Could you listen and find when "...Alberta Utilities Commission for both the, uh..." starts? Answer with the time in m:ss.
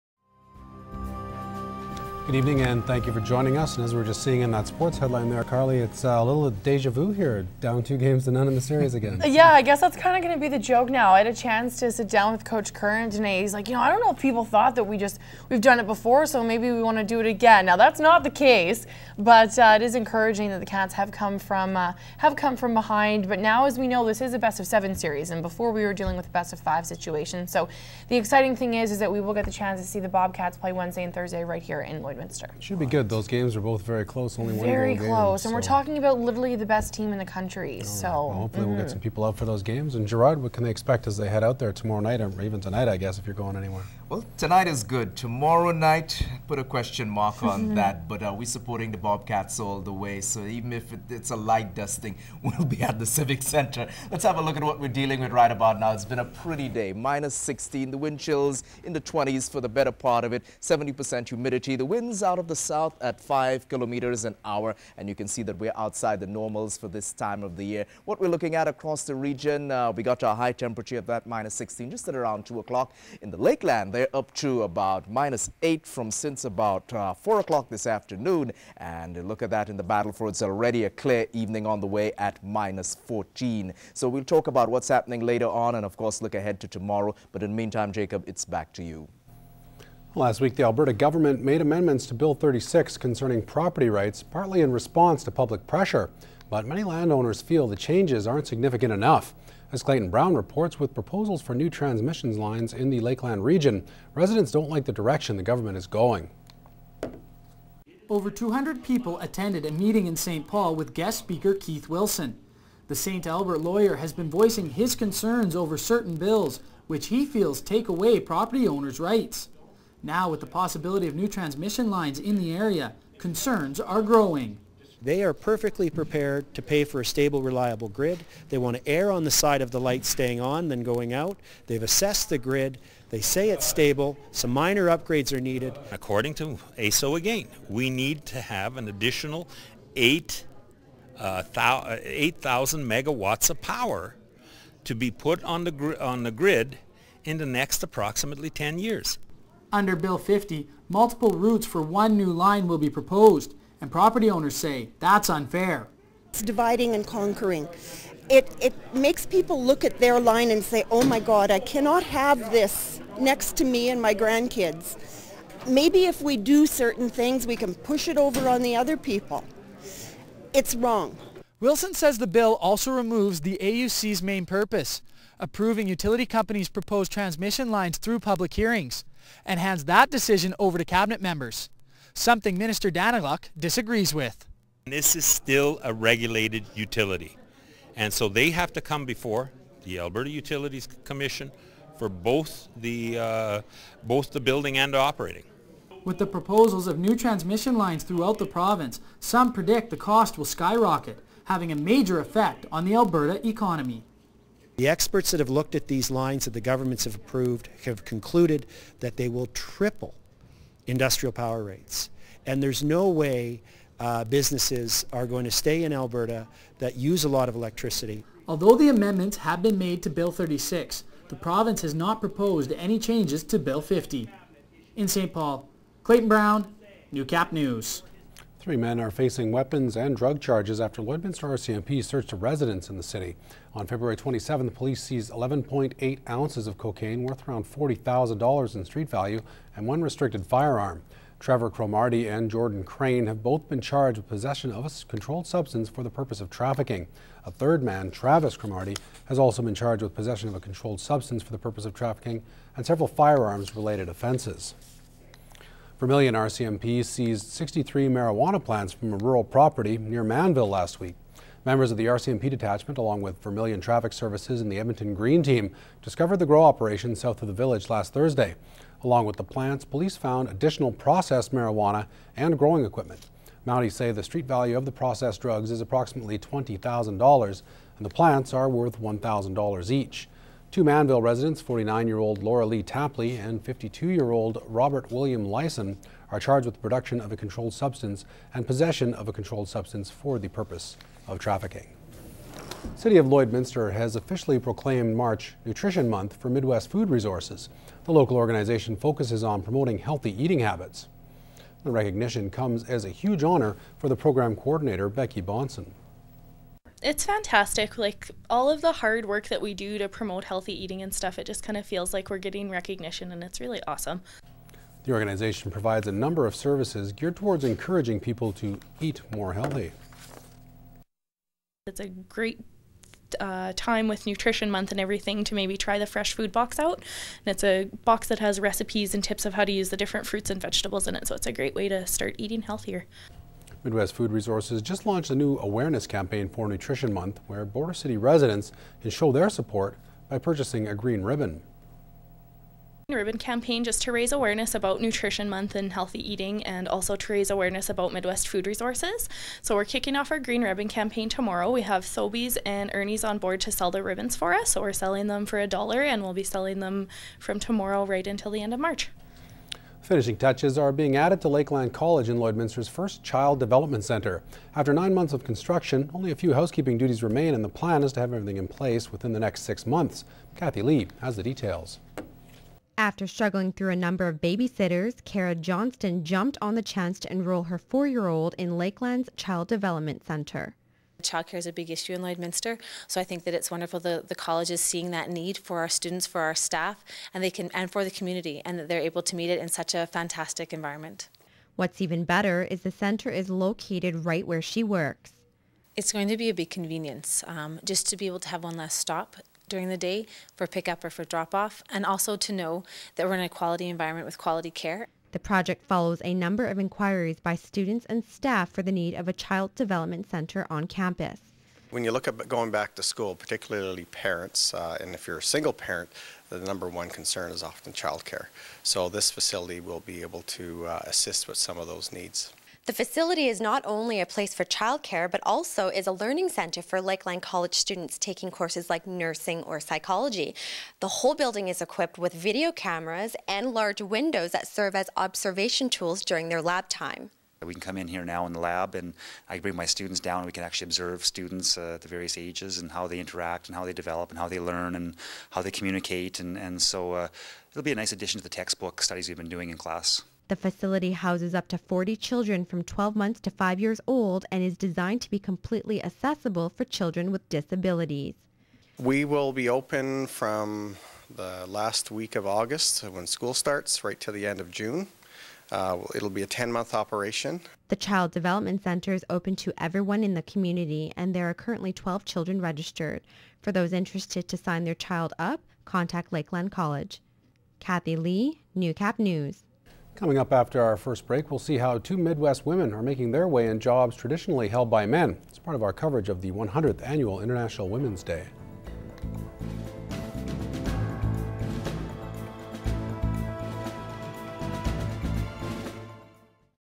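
3:09.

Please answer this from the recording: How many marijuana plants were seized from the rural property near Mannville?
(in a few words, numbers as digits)
63.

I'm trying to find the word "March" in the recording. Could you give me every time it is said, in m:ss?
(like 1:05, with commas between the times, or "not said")
4:55, 5:58.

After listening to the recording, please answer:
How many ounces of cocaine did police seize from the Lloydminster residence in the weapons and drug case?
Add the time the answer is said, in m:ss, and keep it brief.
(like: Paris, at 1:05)
11.8, at 3:55.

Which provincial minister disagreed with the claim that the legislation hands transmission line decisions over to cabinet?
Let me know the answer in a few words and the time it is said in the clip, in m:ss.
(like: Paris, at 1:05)
Danyluk, at 3:02.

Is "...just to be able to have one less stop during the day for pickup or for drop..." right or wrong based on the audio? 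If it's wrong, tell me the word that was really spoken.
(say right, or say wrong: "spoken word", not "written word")
right.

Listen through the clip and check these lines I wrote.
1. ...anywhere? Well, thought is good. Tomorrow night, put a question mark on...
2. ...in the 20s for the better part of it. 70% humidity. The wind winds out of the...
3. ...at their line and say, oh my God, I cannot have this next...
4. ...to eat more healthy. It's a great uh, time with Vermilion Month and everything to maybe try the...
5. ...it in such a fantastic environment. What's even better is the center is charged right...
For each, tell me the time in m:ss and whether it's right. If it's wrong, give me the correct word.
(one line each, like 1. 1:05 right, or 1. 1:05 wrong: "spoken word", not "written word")
1. 0:43 wrong: "tonight", not "thought"
2. 0:58 right
3. 2:39 right
4. 5:18 wrong: "Nutrition", not "Vermilion"
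5. 6:29 wrong: "located", not "charged".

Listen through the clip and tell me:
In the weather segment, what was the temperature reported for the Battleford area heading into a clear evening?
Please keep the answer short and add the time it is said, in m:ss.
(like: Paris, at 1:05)
-14, at 1:22.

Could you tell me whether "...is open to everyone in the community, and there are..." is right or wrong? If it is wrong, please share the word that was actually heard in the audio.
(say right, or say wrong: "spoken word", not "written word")
right.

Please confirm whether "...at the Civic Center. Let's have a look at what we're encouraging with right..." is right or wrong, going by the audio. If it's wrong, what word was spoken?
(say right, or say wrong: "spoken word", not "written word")
wrong: "dealing", not "encouraging".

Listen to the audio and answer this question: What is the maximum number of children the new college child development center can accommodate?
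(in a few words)
40.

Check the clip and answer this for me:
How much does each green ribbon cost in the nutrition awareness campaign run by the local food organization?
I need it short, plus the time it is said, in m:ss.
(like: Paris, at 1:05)
$1, at 5:55.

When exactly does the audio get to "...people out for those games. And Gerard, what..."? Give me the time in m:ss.
0:38.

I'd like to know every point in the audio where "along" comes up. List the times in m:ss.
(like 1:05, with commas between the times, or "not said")
4:22, 4:29.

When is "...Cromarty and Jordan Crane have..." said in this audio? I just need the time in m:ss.
4:01.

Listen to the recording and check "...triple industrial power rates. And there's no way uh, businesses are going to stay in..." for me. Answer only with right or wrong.
right.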